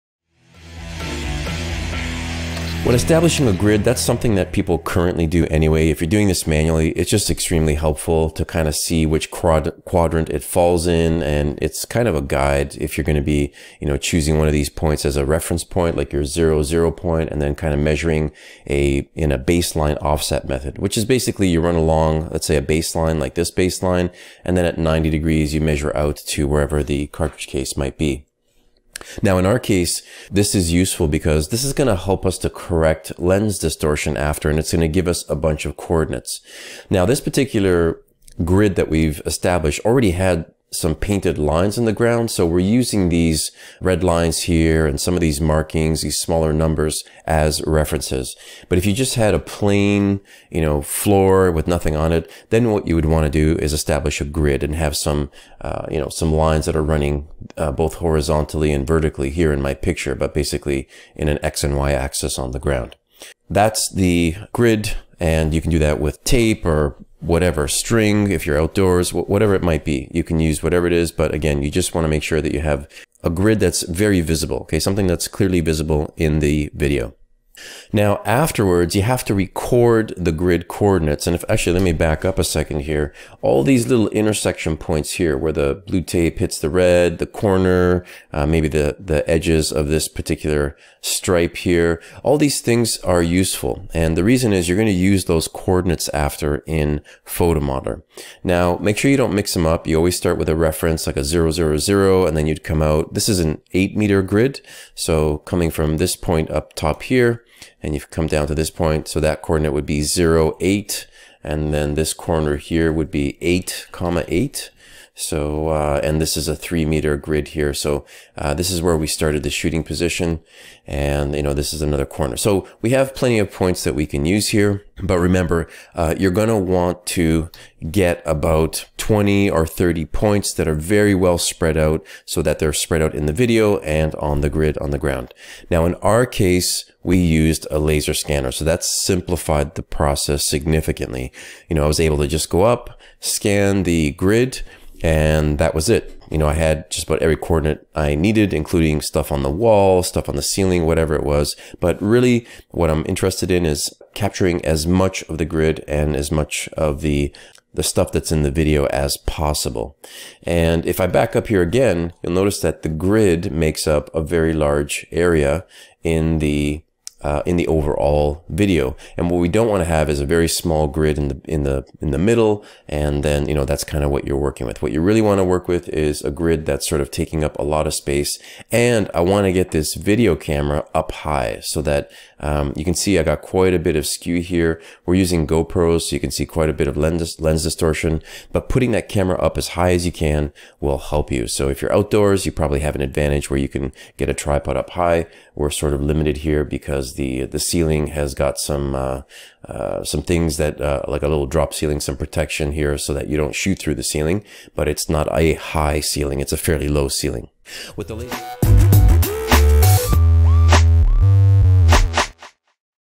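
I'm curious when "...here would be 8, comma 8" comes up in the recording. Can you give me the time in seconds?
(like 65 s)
112 s.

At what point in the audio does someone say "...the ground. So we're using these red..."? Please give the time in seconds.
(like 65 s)
41 s.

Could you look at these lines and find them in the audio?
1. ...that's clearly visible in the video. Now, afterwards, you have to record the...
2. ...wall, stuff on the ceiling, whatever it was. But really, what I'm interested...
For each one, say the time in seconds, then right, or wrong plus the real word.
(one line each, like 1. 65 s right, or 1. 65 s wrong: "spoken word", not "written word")
1. 75 s right
2. 149 s right.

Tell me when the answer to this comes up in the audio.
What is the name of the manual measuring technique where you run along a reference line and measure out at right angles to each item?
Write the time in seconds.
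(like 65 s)
19 s.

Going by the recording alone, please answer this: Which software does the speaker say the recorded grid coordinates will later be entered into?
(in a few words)
photomodeler.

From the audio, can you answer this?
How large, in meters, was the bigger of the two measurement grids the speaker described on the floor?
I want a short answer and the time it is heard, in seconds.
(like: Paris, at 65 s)
8 meter, at 103 s.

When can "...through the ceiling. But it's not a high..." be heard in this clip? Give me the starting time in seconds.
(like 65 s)
203 s.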